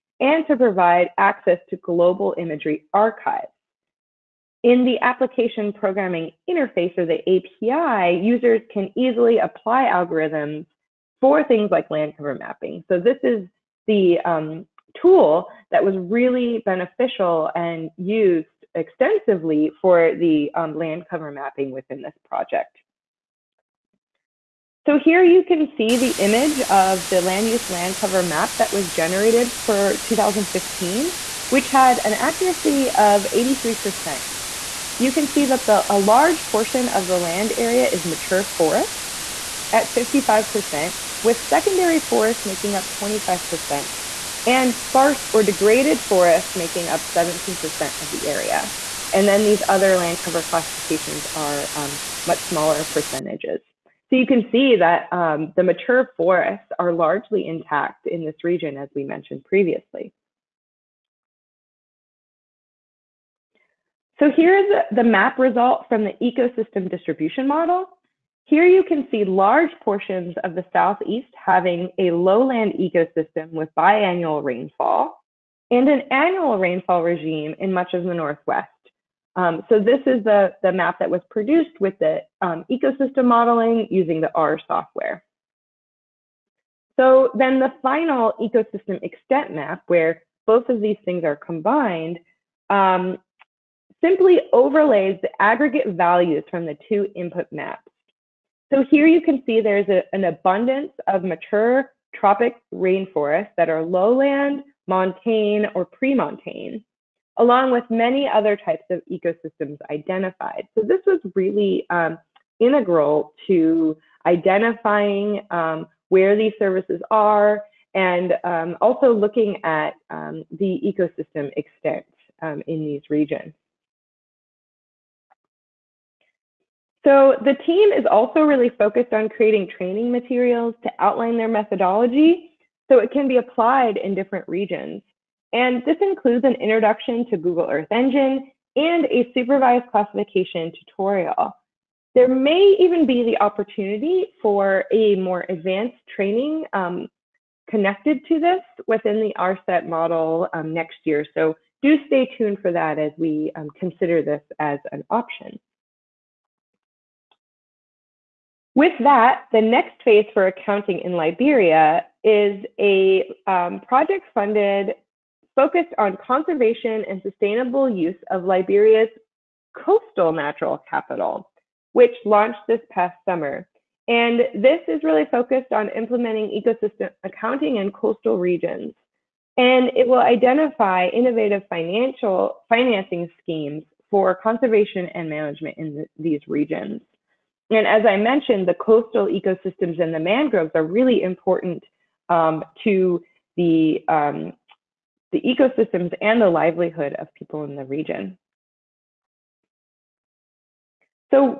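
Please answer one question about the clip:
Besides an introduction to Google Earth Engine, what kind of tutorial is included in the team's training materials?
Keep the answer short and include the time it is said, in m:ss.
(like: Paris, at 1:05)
Supervised classification, at 2:19.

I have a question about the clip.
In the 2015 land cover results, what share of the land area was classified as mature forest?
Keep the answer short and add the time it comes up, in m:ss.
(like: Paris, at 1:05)
55%, at 0:39.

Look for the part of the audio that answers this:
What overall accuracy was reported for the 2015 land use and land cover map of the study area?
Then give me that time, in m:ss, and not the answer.
0:33.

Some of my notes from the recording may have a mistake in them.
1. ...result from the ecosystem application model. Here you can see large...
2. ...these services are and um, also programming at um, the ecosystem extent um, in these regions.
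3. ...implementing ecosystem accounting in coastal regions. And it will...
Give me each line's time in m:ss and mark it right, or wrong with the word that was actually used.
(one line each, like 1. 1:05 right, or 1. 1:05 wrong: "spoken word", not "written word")
1. 1:05 wrong: "distribution", not "application"
2. 1:56 wrong: "looking", not "programming"
3. 2:55 right.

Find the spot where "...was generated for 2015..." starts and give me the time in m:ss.
0:28.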